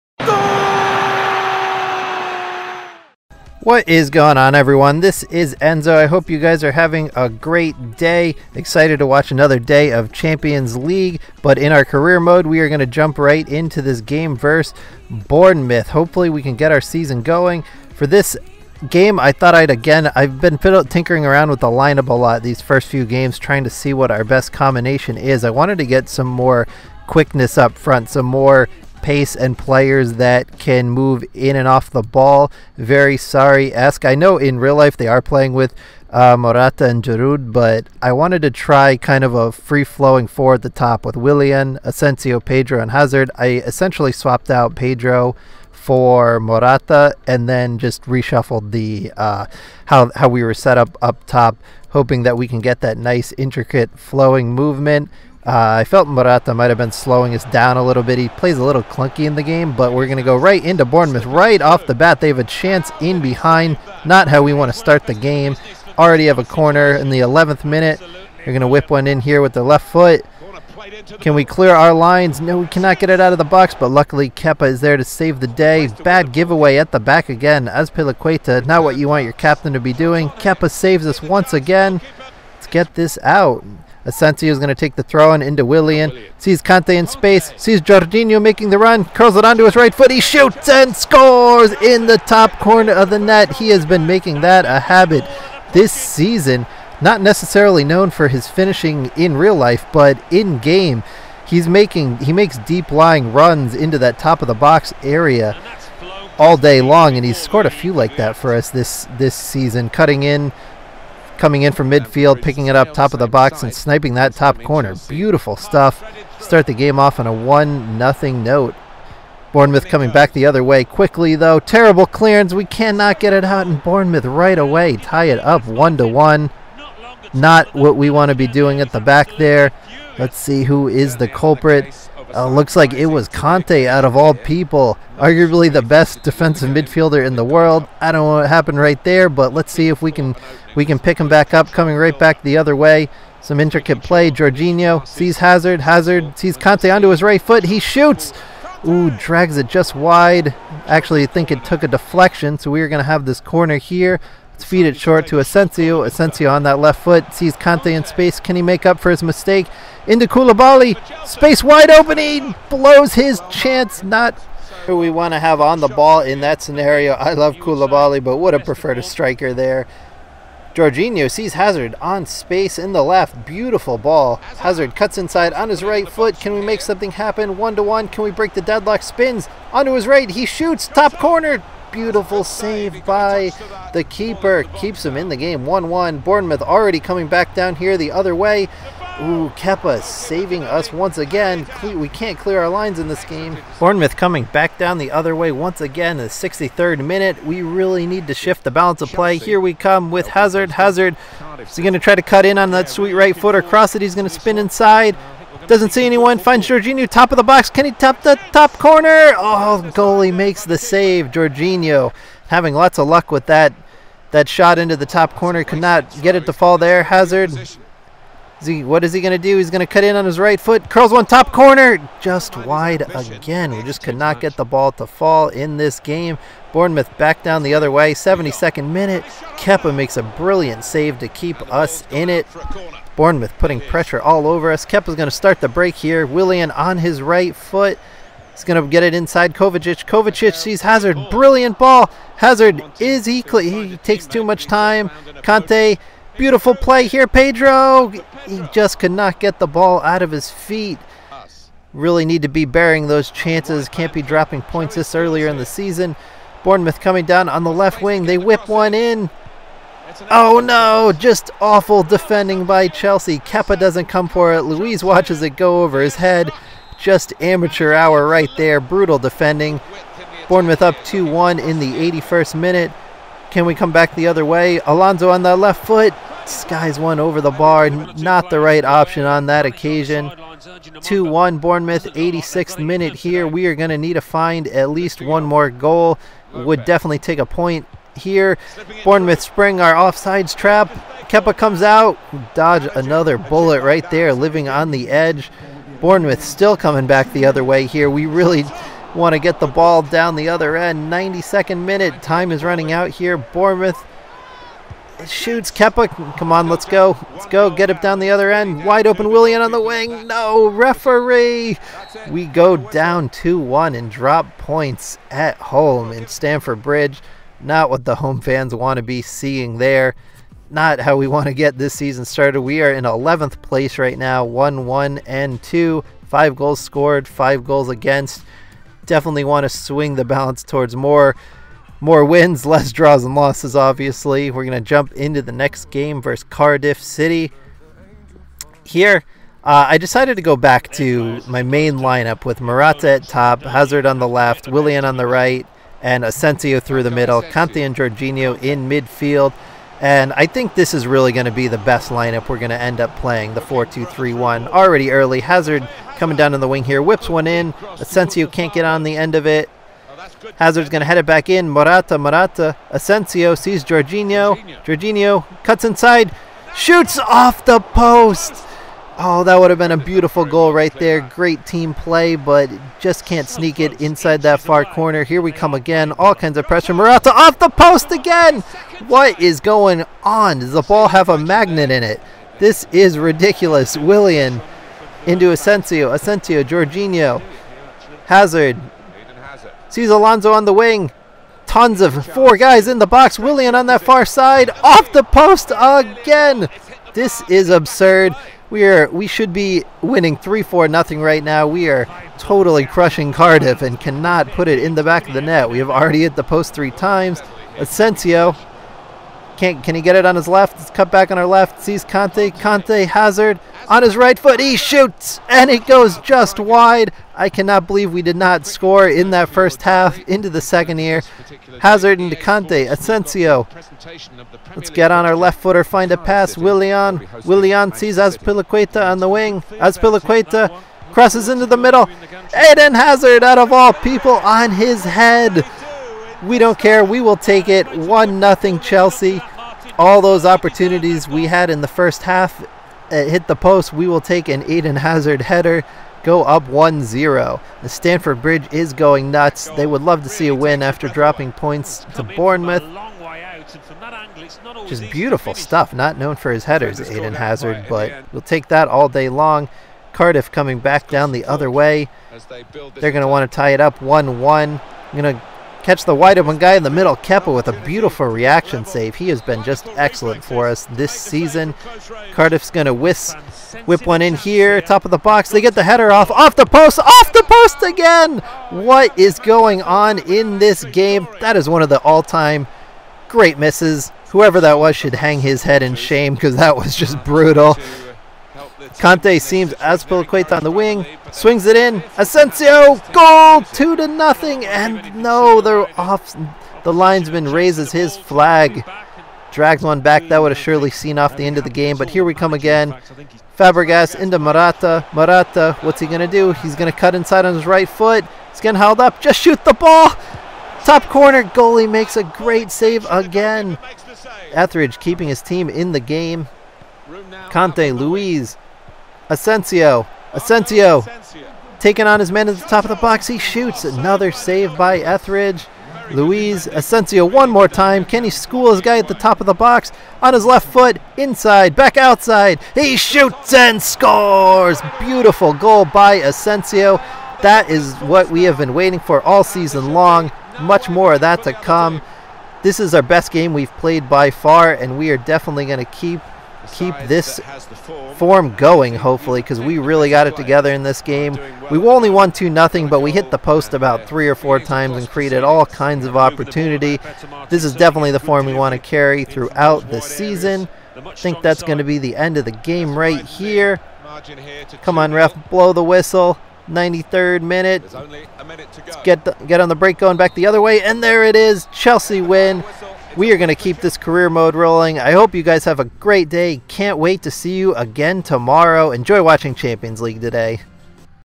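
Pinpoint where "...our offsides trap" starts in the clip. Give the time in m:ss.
4:49.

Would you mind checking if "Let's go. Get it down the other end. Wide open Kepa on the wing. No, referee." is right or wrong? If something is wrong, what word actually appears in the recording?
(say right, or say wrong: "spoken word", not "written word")
wrong: "Willian", not "Kepa".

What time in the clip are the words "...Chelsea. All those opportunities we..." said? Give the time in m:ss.
7:18.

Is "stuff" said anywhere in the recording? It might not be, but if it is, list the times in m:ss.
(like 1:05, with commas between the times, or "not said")
1:55, 7:35.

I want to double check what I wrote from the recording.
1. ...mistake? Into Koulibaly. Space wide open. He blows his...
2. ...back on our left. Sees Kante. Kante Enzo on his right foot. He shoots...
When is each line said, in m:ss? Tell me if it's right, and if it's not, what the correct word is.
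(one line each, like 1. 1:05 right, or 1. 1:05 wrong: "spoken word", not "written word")
1. 2:39 right
2. 6:51 wrong: "Hazard", not "Enzo".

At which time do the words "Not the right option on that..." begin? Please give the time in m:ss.
4:37.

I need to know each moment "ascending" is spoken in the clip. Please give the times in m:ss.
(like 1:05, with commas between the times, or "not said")
not said.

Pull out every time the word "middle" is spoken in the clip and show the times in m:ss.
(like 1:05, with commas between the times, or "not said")
5:47, 7:11, 7:46.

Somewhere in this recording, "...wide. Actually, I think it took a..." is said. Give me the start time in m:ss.
2:29.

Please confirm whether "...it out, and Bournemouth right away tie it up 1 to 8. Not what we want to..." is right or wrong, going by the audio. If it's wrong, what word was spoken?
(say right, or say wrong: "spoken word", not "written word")
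wrong: "1", not "8".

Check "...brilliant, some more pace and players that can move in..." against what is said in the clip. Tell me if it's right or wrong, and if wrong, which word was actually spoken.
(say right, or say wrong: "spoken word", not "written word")
wrong: "front", not "brilliant".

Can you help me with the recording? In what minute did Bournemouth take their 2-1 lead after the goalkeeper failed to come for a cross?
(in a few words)
81st.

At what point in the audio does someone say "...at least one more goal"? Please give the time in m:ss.
4:44.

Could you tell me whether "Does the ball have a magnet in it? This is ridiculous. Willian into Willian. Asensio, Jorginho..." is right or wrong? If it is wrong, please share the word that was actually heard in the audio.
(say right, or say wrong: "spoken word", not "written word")
wrong: "Asensio", not "Willian".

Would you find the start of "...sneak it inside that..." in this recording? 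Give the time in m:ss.
6:13.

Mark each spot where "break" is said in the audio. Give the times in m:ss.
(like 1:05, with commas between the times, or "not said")
2:58, 3:55, 9:29.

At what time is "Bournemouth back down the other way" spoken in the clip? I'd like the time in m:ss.
3:46.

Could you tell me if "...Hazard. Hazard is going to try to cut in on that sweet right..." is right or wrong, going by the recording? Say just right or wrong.
right.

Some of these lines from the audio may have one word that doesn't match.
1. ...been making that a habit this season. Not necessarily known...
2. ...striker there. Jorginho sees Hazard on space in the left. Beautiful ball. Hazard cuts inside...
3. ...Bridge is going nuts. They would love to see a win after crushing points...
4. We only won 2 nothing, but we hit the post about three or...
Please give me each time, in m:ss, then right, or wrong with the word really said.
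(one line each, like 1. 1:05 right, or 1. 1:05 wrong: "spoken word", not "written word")
1. 1:33 right
2. 2:49 right
3. 7:28 wrong: "dropping", not "crushing"
4. 9:11 right.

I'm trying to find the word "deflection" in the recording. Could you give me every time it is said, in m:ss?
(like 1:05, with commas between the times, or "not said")
2:31.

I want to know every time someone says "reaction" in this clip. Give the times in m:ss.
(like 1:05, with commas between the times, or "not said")
7:48.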